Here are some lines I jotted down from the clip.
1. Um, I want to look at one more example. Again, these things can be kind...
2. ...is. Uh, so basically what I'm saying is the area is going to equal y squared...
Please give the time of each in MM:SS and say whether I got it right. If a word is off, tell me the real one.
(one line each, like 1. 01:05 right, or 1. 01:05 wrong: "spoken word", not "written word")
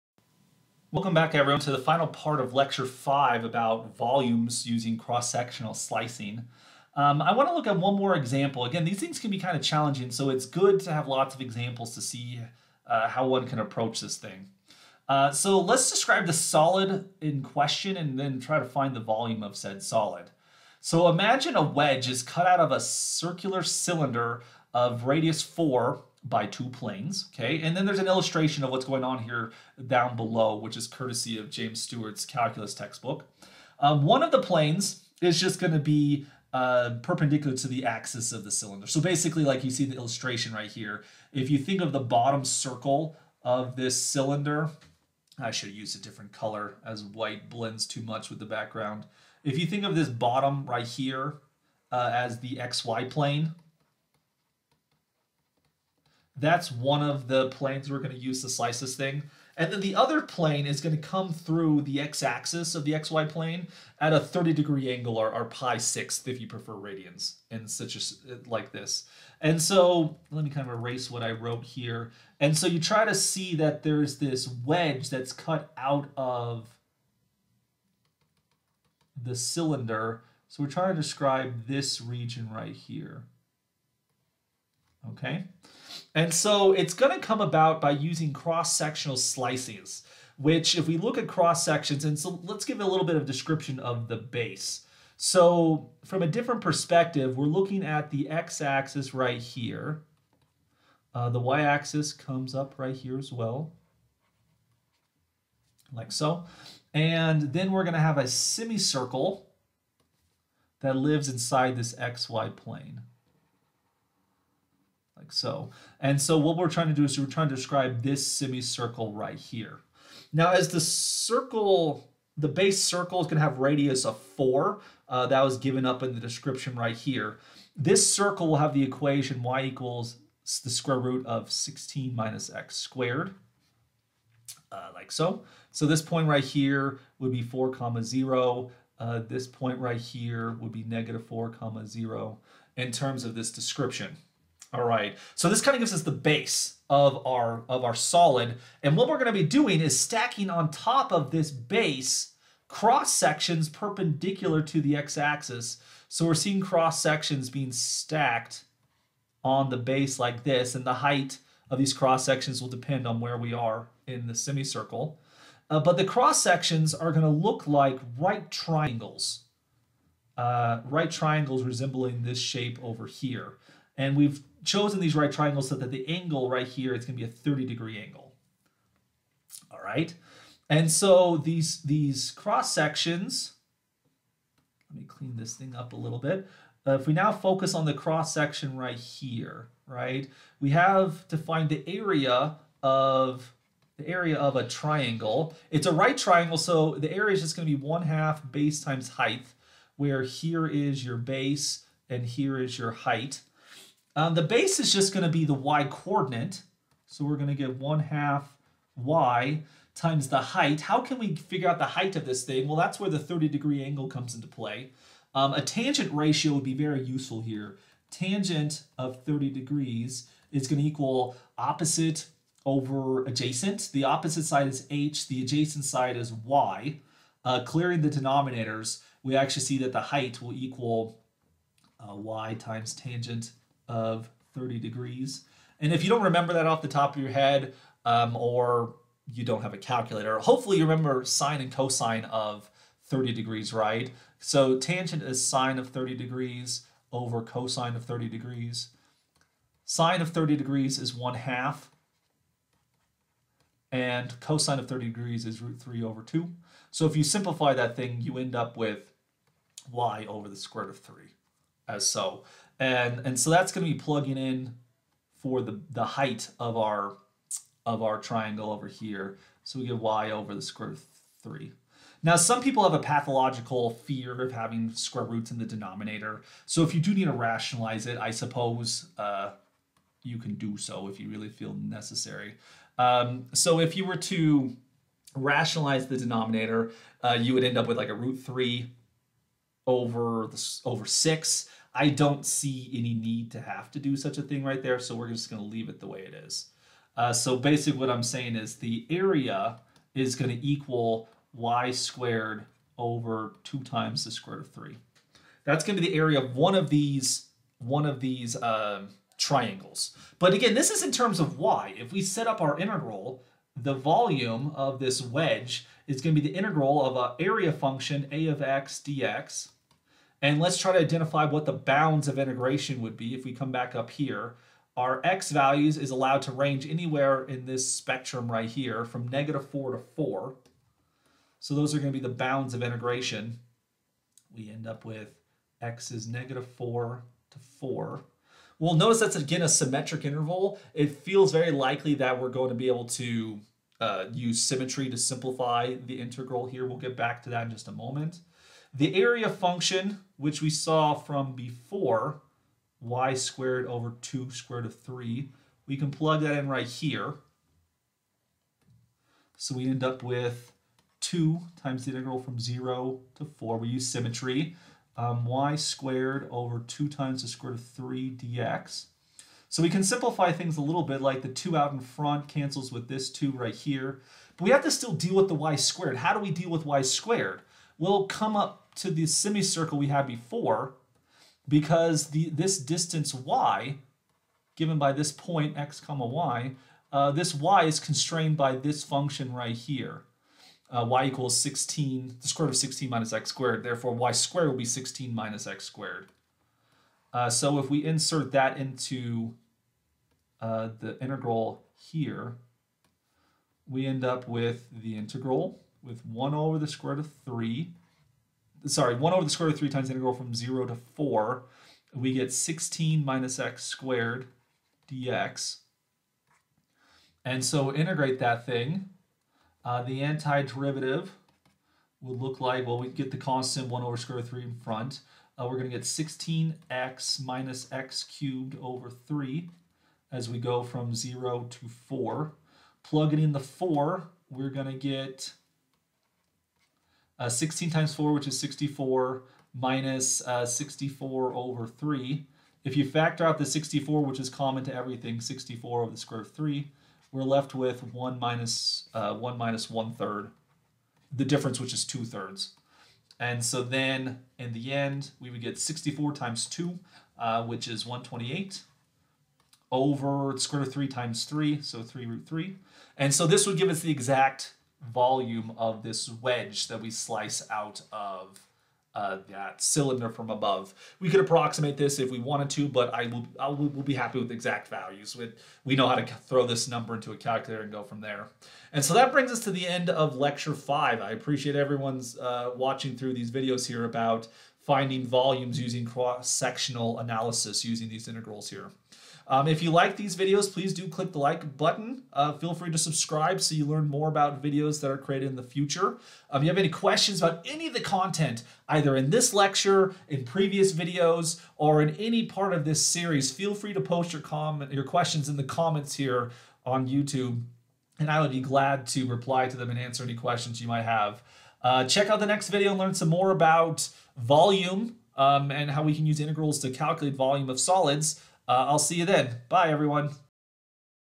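1. 00:06 right
2. 04:56 right.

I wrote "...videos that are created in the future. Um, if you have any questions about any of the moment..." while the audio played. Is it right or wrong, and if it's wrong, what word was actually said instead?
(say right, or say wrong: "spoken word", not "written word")
wrong: "content", not "moment".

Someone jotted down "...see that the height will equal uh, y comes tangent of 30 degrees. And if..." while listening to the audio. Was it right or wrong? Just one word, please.
wrong.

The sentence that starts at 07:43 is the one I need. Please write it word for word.
And so this would give us the exact volume of this wedge that we slice out of uh, that cylinder from above.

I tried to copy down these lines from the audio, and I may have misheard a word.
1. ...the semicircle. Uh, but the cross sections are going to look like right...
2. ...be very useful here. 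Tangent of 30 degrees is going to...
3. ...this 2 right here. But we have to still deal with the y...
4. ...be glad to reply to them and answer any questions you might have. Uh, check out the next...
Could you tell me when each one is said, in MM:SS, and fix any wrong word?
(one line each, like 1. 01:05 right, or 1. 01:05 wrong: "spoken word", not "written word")
1. 02:44 right
2. 03:36 right
3. 06:13 right
4. 08:28 right.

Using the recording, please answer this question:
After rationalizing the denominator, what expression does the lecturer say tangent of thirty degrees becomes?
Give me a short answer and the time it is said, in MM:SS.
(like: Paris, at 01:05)
root 3 over 6, at 04:48.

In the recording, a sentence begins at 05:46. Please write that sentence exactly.
We'll get back to that in just a moment.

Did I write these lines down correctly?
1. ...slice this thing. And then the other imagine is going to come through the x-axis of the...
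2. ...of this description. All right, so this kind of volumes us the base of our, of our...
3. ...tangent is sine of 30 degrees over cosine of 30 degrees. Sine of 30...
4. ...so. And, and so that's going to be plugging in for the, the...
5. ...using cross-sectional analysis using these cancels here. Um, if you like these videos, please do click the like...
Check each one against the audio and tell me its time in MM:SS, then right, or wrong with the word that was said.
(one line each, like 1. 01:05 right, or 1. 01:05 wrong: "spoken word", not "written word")
1. 00:58 wrong: "plane", not "imagine"
2. 02:23 wrong: "gives", not "volumes"
3. 04:04 right
4. 04:22 right
5. 08:05 wrong: "integrals", not "cancels".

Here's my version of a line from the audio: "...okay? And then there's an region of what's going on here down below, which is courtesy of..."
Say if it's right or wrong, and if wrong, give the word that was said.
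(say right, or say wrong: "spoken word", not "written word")
wrong: "illustration", not "region".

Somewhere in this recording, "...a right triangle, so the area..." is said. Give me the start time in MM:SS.
03:15.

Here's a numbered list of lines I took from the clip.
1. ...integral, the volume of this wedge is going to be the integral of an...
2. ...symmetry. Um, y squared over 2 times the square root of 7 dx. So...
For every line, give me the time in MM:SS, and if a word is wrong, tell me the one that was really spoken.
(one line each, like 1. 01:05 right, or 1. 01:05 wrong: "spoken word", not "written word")
1. 05:12 right
2. 06:04 wrong: "3", not "7".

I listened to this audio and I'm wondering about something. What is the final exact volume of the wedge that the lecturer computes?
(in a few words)
128/(3√3).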